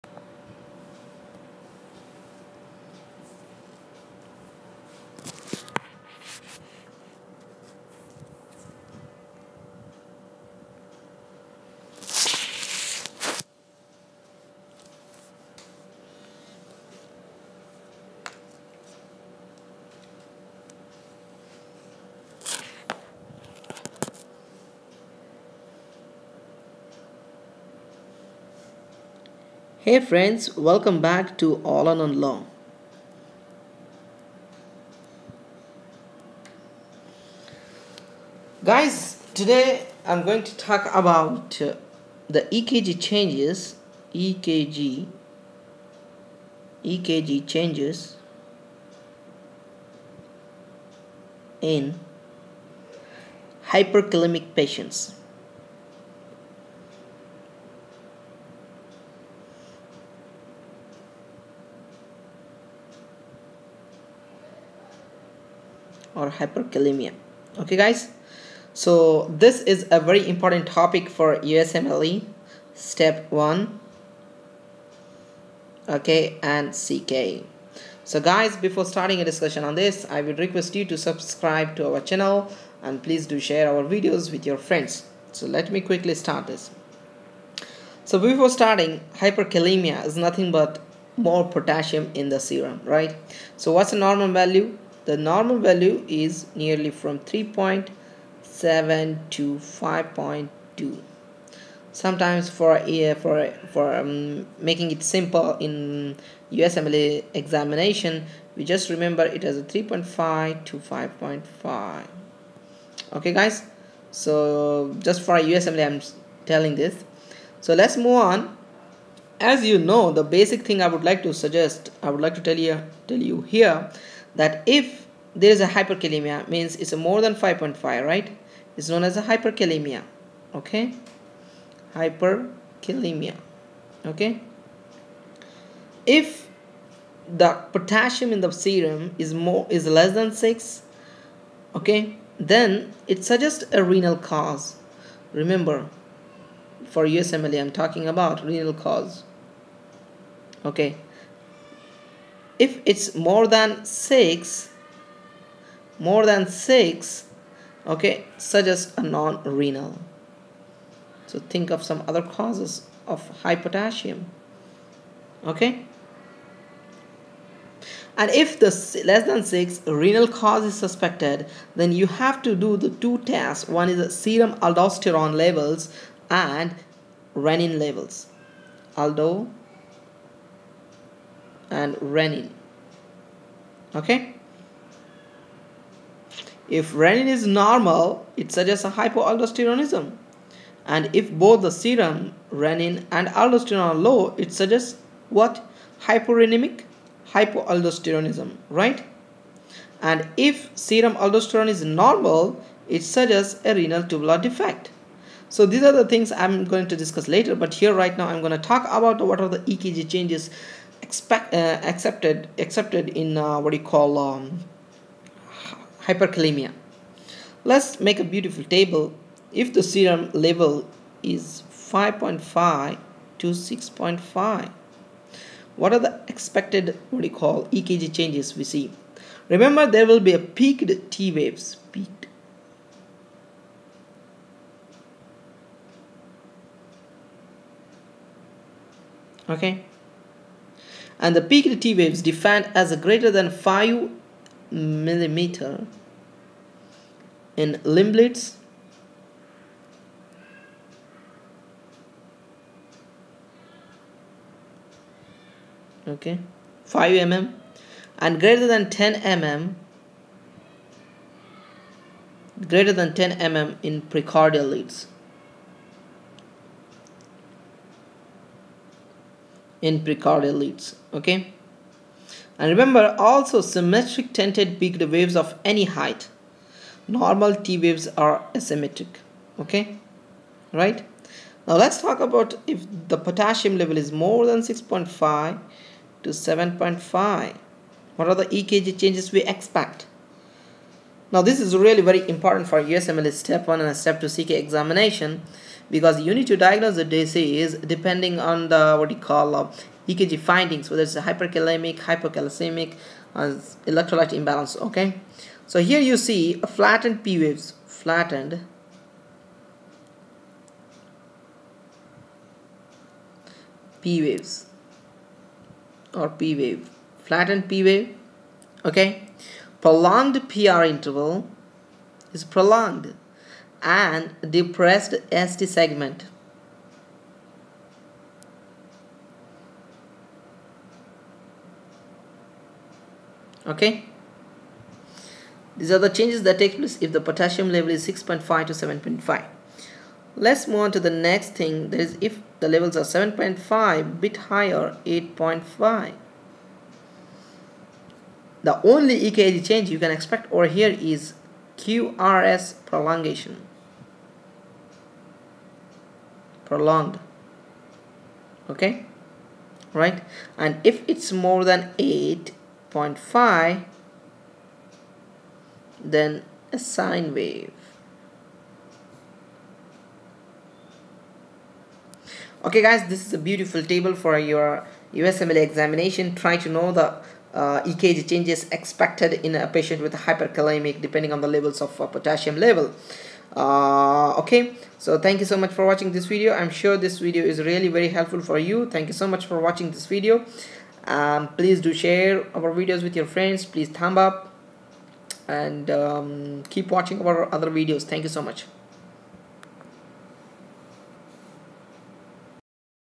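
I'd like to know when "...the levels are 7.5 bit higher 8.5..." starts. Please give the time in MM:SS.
05:42.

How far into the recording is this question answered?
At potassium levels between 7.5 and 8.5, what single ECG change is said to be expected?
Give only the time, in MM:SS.
05:51.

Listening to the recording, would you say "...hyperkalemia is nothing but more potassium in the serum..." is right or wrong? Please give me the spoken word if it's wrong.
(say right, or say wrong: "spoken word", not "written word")
right.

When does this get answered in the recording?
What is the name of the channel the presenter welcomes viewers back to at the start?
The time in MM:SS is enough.
00:31.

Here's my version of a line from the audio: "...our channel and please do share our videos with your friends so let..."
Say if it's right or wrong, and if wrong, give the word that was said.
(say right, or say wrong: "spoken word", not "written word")
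right.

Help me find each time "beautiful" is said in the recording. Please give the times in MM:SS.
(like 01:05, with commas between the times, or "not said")
03:38, 06:13.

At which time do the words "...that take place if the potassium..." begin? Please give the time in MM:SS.
05:36.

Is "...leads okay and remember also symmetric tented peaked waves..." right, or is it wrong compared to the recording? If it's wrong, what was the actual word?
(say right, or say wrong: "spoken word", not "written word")
right.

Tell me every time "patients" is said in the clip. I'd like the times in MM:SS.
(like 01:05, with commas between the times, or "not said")
00:54, 06:19.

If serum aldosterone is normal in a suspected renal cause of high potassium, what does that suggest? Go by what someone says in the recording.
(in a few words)
renal tubular defect.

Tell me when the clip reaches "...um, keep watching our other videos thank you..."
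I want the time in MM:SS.
06:35.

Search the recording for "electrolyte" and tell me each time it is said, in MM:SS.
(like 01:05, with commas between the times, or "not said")
05:03.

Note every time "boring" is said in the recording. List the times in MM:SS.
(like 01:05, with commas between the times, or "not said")
not said.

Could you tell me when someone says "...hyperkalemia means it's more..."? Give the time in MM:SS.
02:05.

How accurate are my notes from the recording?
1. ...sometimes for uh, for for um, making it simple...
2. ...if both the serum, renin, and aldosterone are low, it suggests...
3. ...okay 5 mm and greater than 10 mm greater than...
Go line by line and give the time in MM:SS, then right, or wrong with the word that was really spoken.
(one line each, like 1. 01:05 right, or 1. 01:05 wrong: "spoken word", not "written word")
1. 01:41 right
2. 03:11 right
3. 04:16 right.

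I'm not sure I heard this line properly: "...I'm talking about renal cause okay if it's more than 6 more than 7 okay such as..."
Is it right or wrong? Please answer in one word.
wrong.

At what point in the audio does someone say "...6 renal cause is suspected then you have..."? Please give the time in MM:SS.
02:49.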